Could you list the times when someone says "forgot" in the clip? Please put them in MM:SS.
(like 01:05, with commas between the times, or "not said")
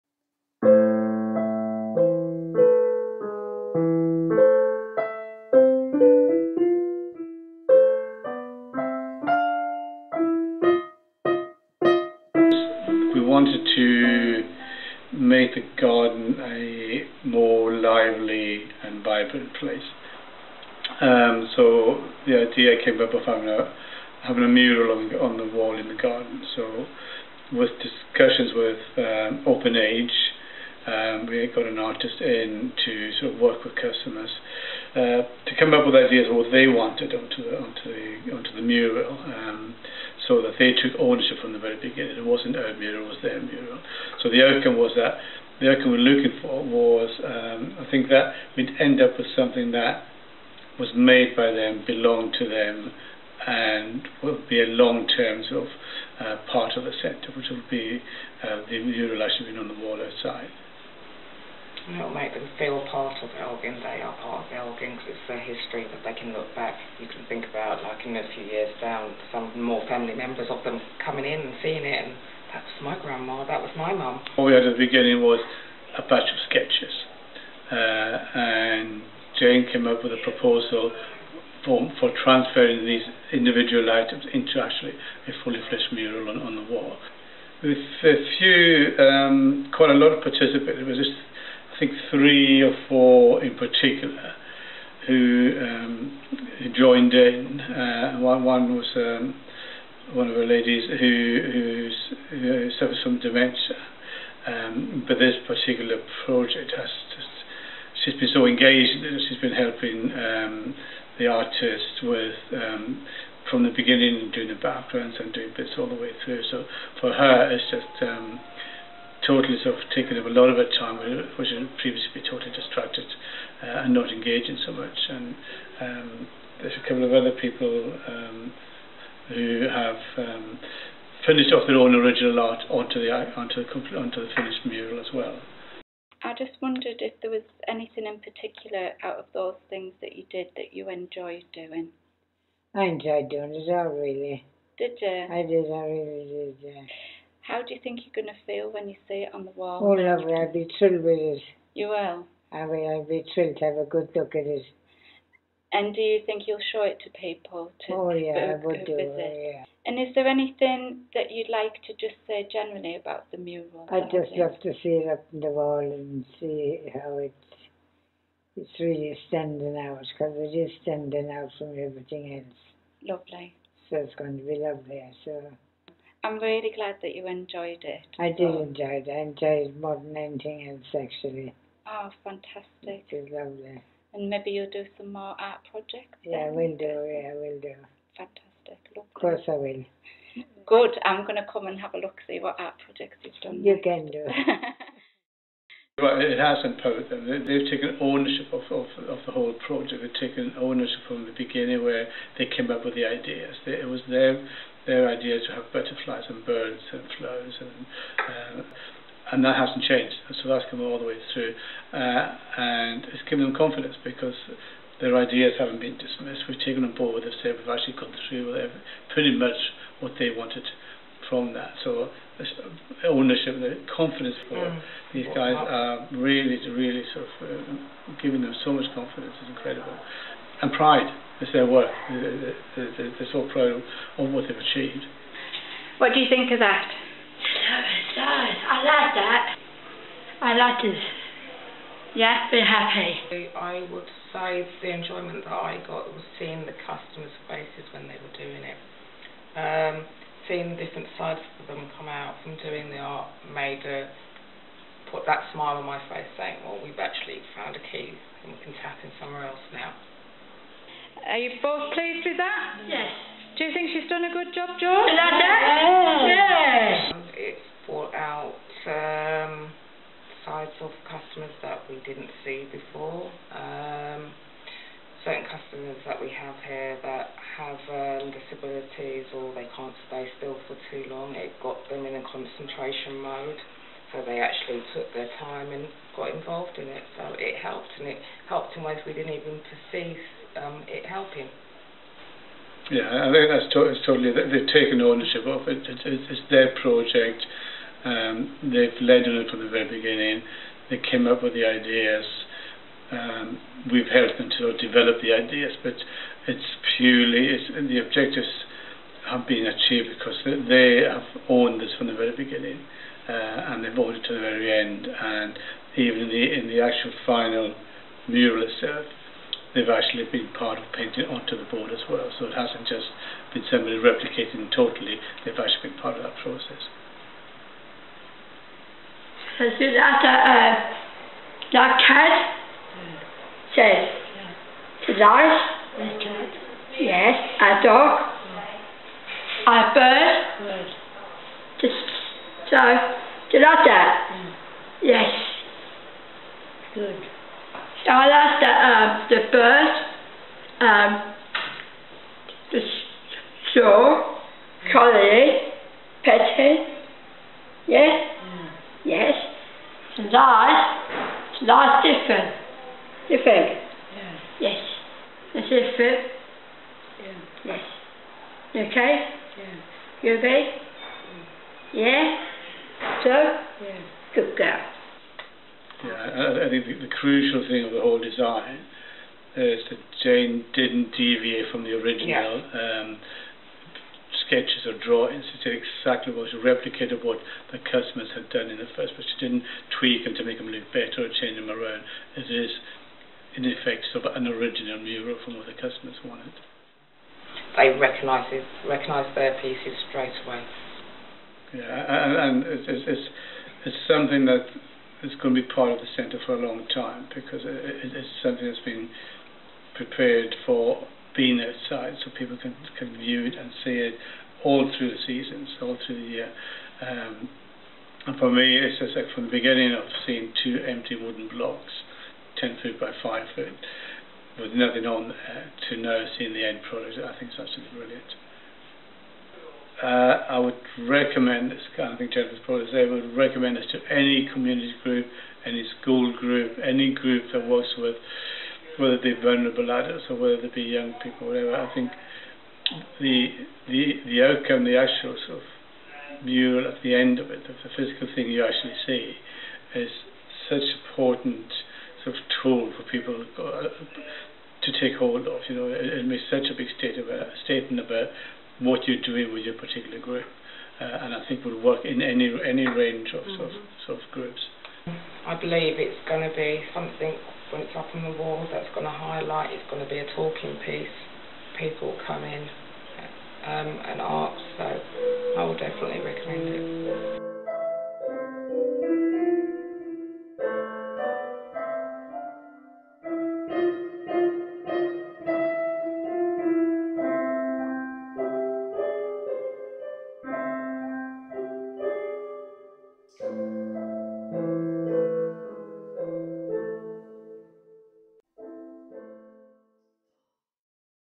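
not said.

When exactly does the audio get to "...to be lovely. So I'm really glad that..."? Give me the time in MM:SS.
02:54.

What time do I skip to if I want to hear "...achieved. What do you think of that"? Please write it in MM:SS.
03:54.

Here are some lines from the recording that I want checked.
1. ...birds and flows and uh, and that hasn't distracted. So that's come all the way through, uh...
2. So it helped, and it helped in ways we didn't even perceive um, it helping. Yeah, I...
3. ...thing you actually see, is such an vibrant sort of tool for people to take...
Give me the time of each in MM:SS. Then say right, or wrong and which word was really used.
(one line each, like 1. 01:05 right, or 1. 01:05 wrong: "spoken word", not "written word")
1. 03:26 wrong: "changed", not "distracted"
2. 04:47 right
3. 07:28 wrong: "important", not "vibrant".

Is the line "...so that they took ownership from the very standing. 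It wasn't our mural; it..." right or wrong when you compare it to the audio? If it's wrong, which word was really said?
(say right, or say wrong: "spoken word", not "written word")
wrong: "beginning", not "standing".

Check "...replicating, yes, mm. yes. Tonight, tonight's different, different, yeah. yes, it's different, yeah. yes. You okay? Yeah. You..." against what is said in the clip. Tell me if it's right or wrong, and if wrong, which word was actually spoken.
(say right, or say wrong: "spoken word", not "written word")
wrong: "petting", not "replicating".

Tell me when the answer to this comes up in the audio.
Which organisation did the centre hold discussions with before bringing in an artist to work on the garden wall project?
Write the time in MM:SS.
00:29.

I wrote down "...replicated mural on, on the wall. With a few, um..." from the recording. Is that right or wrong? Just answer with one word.
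wrong.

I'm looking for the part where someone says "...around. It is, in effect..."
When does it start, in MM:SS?
06:31.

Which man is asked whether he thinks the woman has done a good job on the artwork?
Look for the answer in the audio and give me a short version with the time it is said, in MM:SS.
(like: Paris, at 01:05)
George, at 04:24.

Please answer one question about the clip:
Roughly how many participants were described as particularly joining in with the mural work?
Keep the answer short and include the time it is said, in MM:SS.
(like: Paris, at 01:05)
3 or 4, at 01:32.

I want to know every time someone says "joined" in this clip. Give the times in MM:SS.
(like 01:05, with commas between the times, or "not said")
01:36.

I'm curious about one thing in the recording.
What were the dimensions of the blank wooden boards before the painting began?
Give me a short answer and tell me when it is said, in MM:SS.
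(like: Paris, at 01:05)
10 foot by 5 foot, at 07:02.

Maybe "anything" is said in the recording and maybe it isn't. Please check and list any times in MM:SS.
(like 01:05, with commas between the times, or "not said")
02:17, 02:40, 03:00.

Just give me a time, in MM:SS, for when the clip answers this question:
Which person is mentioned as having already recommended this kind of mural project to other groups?
07:12.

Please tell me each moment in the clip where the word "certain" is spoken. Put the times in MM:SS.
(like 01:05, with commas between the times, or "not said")
04:35.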